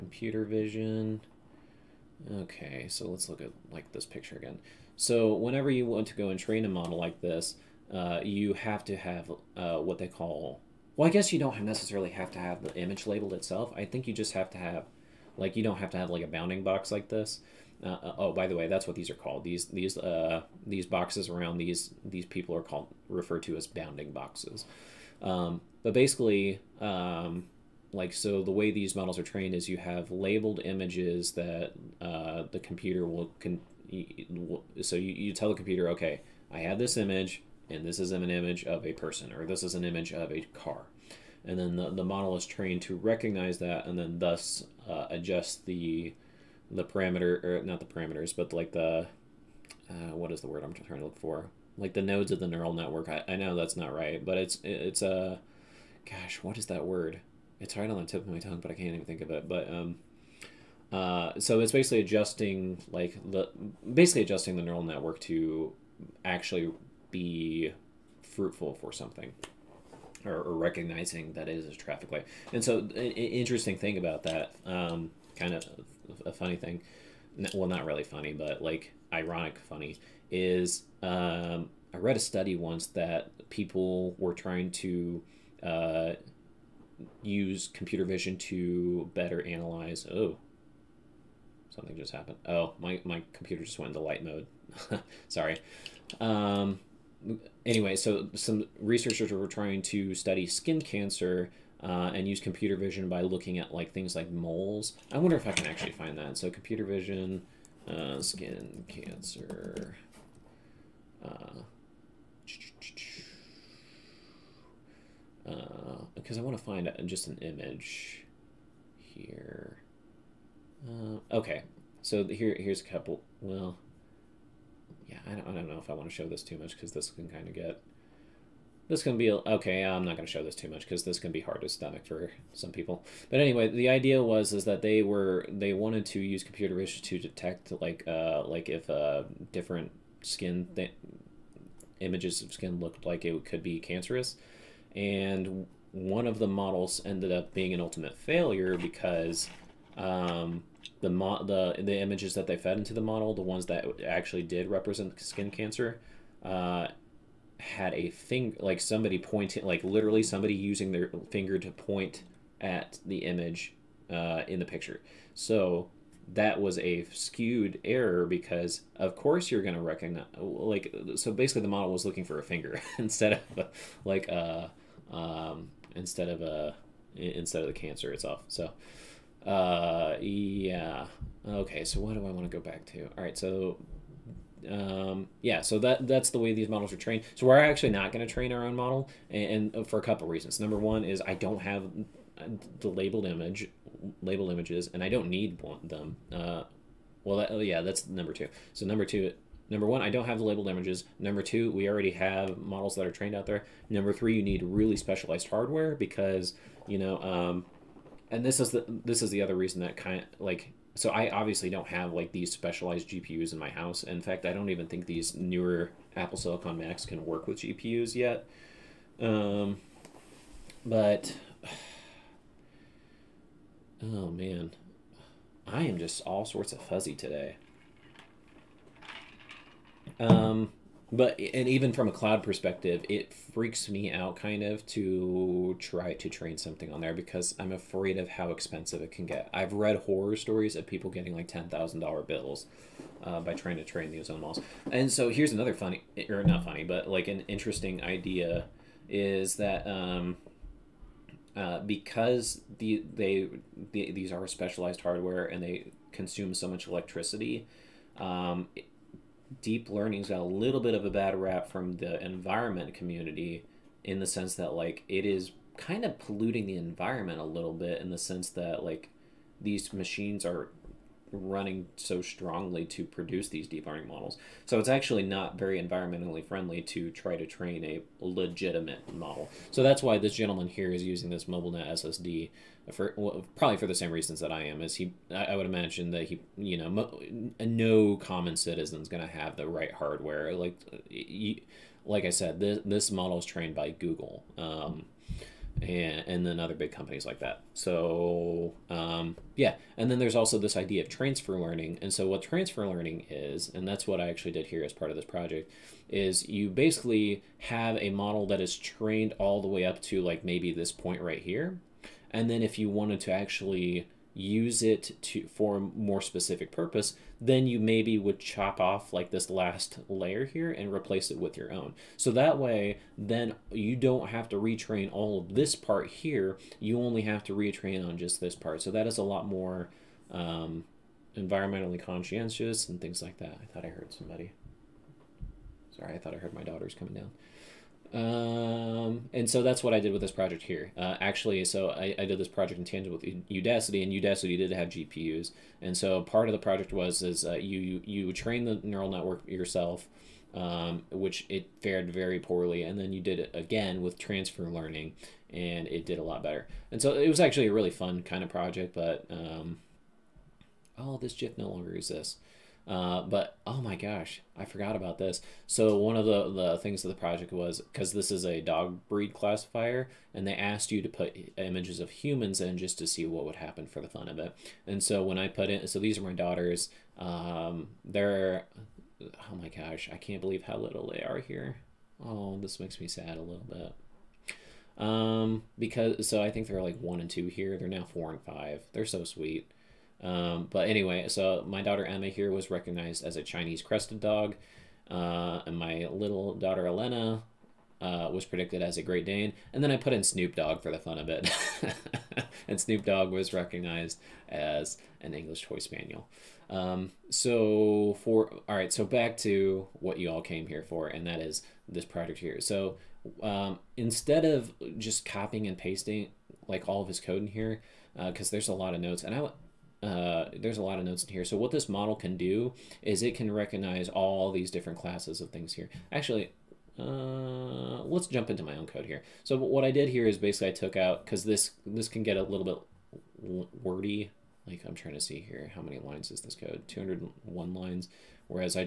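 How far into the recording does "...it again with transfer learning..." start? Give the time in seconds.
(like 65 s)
353 s.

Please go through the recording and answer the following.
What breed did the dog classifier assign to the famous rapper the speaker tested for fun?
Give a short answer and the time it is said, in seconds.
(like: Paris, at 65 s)
English Toy Spaniel, at 405 s.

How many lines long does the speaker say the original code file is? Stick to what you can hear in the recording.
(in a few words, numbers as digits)
201.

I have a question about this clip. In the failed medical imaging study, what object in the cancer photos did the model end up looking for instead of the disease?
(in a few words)
a finger.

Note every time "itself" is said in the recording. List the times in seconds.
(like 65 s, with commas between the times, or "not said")
13 s, 178 s.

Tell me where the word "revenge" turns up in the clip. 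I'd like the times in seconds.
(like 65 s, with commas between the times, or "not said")
not said.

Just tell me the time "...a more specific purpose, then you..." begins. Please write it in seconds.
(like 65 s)
315 s.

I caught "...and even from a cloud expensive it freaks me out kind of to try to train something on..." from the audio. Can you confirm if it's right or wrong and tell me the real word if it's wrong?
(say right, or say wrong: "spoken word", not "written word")
wrong: "perspective", not "expensive".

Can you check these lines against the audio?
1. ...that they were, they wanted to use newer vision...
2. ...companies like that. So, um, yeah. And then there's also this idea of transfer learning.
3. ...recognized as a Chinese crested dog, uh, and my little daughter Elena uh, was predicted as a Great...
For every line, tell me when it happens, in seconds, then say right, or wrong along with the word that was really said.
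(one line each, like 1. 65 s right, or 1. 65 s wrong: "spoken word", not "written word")
1. 134 s wrong: "computer", not "newer"
2. 296 s right
3. 392 s right.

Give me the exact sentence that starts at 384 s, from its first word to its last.
Um, because so I think they're like one and two here.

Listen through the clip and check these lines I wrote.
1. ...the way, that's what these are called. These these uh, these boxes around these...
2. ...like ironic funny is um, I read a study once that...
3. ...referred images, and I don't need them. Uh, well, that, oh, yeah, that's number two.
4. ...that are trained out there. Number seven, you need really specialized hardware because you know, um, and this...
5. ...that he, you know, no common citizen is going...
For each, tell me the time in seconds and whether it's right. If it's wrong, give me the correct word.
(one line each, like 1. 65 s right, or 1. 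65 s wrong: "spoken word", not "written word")
1. 18 s right
2. 78 s right
3. 194 s wrong: "labeled", not "referred"
4. 202 s wrong: "three", not "seven"
5. 286 s right.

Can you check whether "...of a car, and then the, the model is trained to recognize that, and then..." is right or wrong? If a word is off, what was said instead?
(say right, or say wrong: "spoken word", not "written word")
right.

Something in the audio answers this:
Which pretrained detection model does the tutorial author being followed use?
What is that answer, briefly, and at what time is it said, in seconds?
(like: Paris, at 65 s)
MobileNet SSD, at 281 s.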